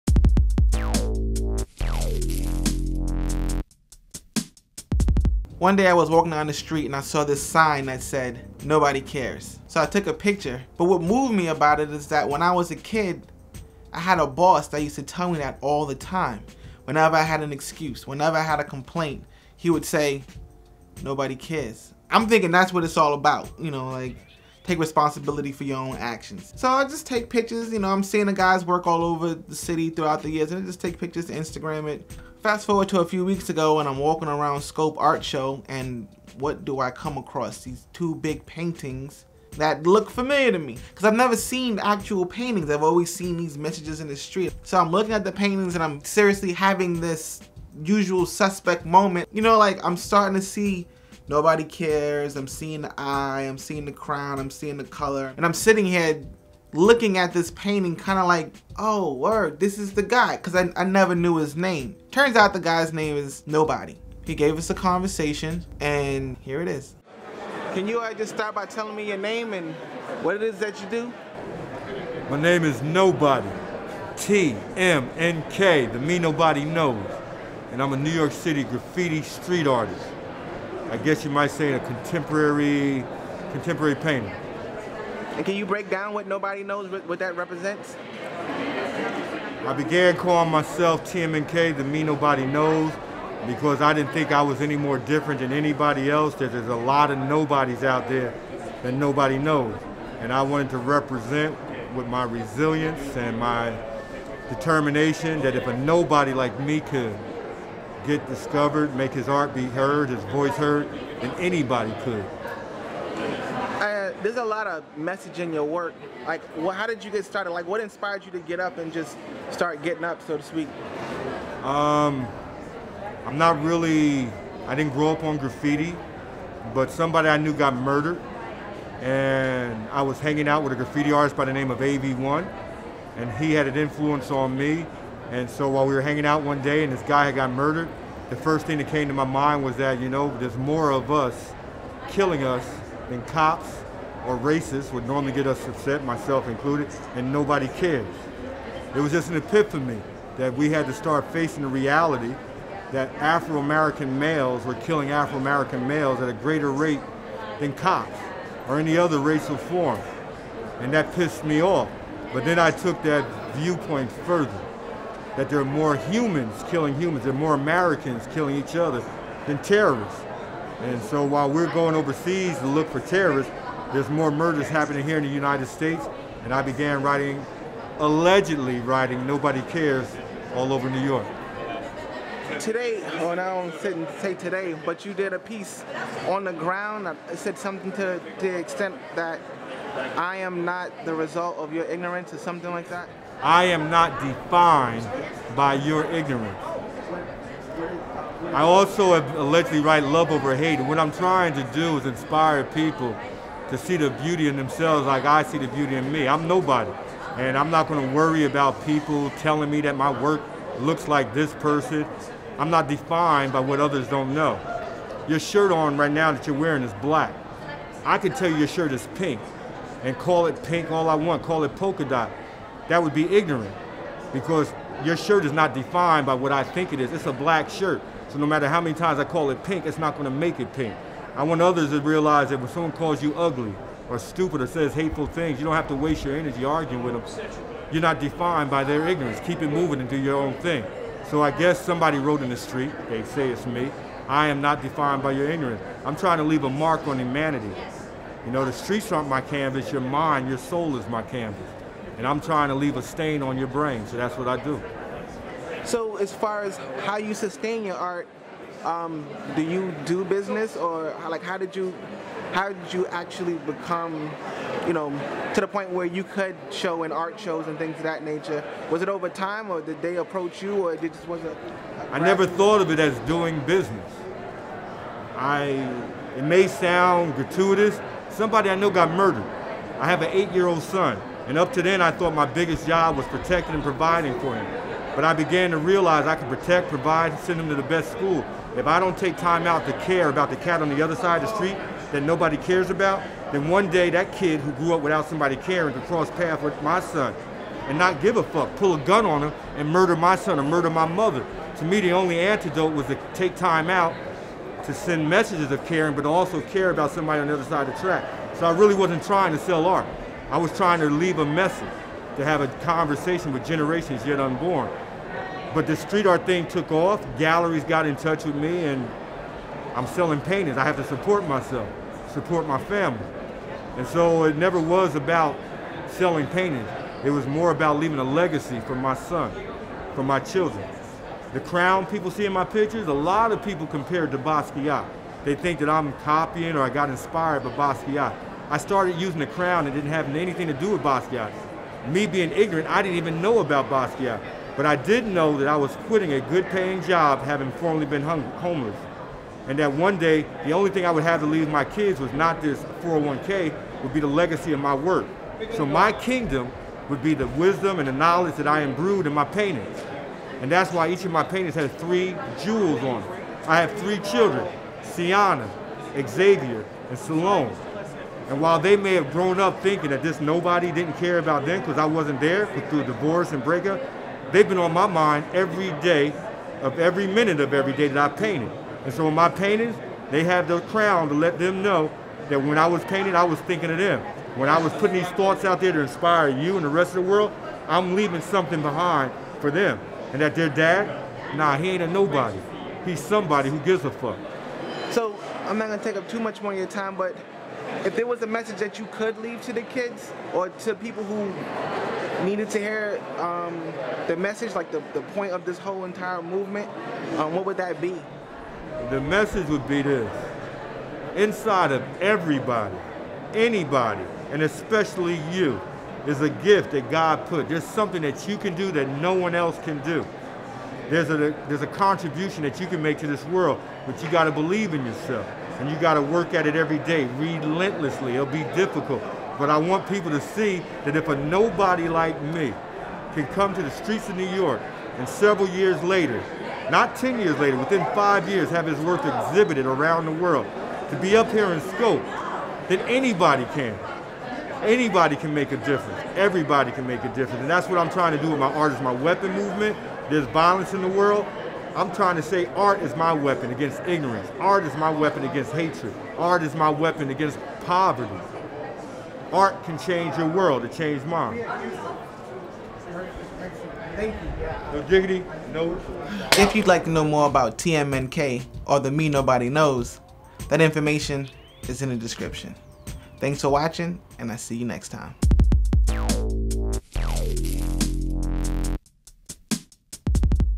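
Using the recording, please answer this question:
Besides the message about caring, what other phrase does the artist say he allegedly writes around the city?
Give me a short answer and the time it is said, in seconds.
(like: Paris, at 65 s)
Love over hate, at 200 s.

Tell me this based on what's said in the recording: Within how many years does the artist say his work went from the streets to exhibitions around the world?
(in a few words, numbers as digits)
5.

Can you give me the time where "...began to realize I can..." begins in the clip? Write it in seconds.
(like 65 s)
285 s.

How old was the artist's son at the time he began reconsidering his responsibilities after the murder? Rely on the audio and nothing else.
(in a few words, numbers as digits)
8.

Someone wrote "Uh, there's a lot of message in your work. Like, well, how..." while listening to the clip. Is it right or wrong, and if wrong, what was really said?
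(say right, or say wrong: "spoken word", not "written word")
right.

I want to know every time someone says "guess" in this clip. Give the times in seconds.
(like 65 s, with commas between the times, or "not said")
80 s, 241 s.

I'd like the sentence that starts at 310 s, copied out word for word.
I was trying to leave a message, to have a conversation with generations yet unborn.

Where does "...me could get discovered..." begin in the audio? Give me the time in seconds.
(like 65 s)
106 s.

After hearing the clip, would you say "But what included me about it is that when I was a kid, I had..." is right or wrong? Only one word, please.
wrong.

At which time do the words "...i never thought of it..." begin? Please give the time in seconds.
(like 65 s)
272 s.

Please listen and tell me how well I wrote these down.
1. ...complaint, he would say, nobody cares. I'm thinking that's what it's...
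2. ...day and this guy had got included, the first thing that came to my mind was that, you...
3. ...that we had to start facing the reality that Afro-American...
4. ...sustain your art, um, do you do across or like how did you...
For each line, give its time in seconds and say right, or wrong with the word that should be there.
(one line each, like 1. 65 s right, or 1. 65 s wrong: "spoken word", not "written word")
1. 18 s right
2. 136 s wrong: "murdered", not "included"
3. 150 s right
4. 257 s wrong: "business", not "across".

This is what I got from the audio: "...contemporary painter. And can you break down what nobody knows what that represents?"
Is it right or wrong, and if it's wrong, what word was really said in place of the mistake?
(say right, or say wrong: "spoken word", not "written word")
right.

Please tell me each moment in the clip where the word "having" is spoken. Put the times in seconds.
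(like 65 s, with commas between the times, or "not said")
46 s, 347 s.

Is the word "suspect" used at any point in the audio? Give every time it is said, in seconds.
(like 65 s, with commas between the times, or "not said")
48 s.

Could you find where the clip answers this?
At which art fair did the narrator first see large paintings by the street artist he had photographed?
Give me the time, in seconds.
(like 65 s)
34 s.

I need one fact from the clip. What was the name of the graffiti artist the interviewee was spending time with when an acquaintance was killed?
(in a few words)
AV1.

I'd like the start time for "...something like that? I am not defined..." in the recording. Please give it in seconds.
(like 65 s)
192 s.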